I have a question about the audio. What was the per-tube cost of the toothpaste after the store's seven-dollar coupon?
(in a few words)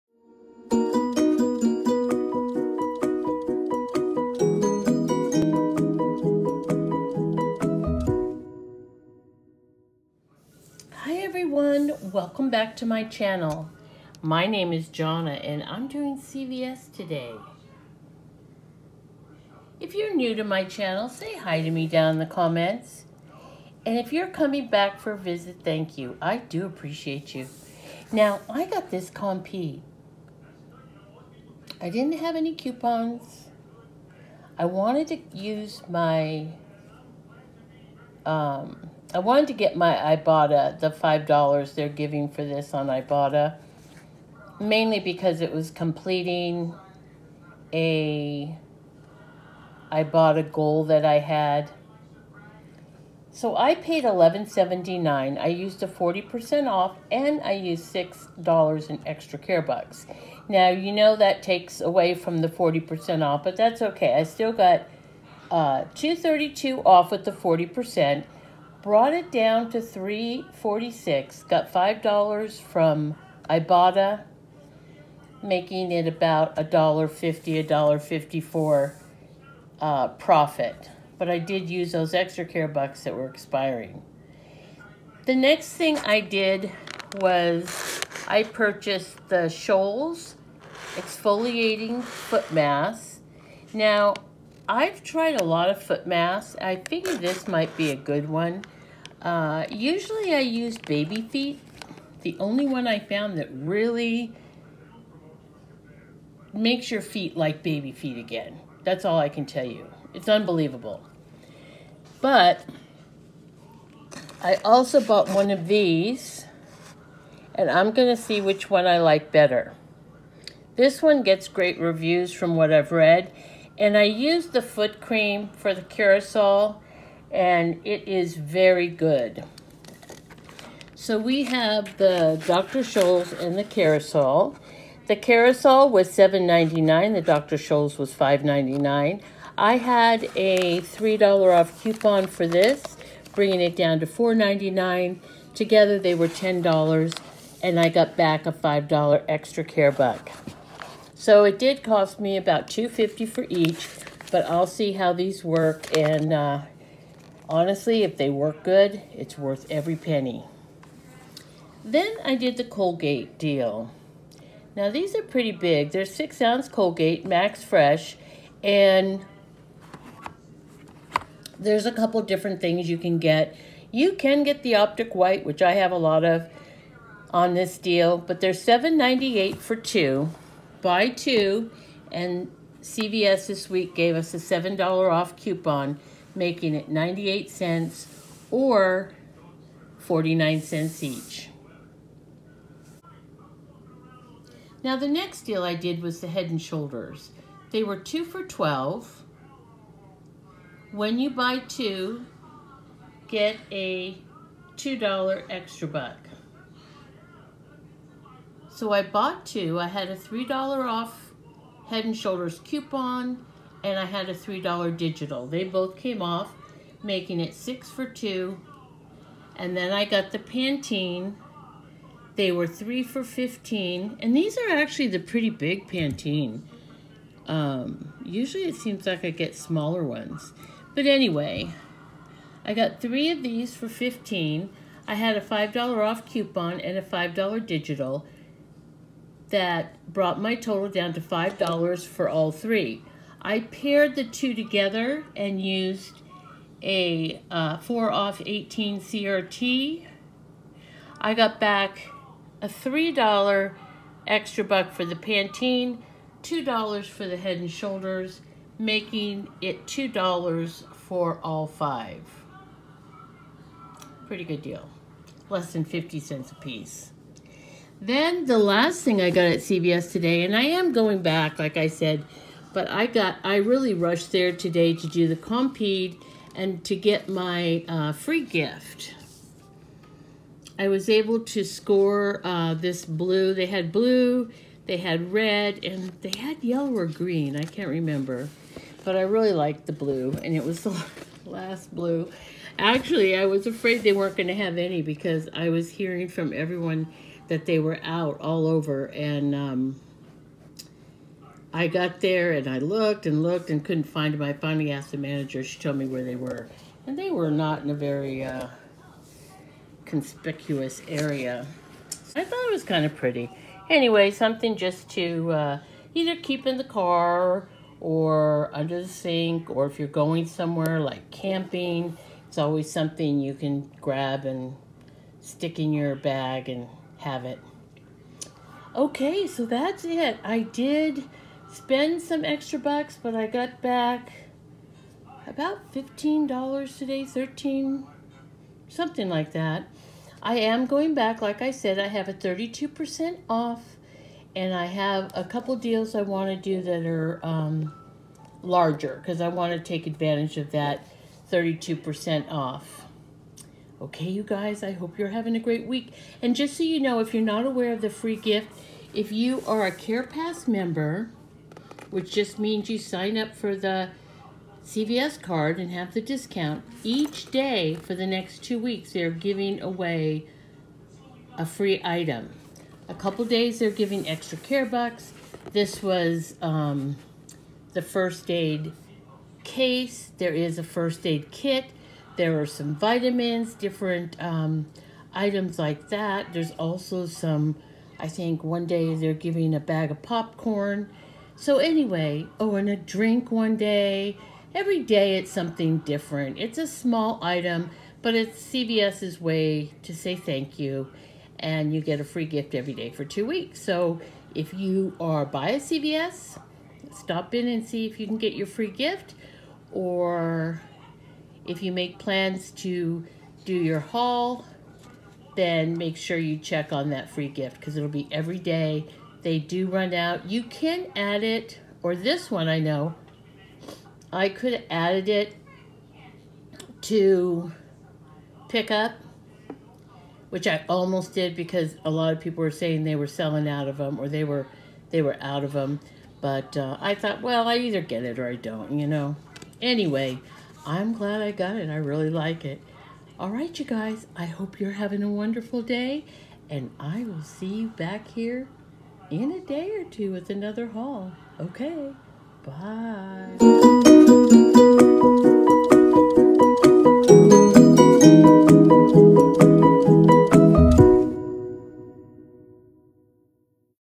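49 cents.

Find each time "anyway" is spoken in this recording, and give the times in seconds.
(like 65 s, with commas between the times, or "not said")
231 s, 313 s, 391 s, 439 s.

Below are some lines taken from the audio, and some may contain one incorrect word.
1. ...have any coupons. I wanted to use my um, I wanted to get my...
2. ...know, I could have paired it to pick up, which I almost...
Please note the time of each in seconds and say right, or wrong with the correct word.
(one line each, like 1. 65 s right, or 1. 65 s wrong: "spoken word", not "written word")
1. 32 s right
2. 422 s wrong: "added", not "paired".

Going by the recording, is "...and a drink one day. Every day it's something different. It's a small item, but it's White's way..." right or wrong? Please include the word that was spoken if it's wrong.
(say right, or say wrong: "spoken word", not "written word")
wrong: "CVS", not "White".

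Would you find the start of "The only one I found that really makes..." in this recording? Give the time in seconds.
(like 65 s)
102 s.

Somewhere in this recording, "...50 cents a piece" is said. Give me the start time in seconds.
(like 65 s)
265 s.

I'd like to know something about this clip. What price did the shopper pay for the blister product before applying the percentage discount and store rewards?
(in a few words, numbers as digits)
$11.79.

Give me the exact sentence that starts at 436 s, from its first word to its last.
But uh, I thought, well, I either get it or I don't, you know.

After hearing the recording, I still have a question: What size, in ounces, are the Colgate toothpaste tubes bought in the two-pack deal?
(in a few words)
6 ounces.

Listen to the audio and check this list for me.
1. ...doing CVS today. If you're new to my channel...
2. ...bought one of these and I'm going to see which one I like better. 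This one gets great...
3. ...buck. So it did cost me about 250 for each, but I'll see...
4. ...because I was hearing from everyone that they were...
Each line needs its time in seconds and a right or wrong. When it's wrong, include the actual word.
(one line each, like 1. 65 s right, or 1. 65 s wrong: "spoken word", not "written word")
1. 15 s right
2. 115 s right
3. 149 s right
4. 295 s right.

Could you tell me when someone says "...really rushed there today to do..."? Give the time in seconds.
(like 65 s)
273 s.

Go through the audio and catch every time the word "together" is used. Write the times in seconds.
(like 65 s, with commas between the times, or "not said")
145 s, 244 s.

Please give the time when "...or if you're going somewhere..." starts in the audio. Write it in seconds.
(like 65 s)
319 s.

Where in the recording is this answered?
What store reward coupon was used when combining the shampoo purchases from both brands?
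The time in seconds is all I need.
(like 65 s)
247 s.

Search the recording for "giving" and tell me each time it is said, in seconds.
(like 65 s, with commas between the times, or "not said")
41 s, 369 s, 373 s, 389 s.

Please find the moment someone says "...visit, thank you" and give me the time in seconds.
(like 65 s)
25 s.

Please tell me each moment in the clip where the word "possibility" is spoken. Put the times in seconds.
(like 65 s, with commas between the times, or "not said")
not said.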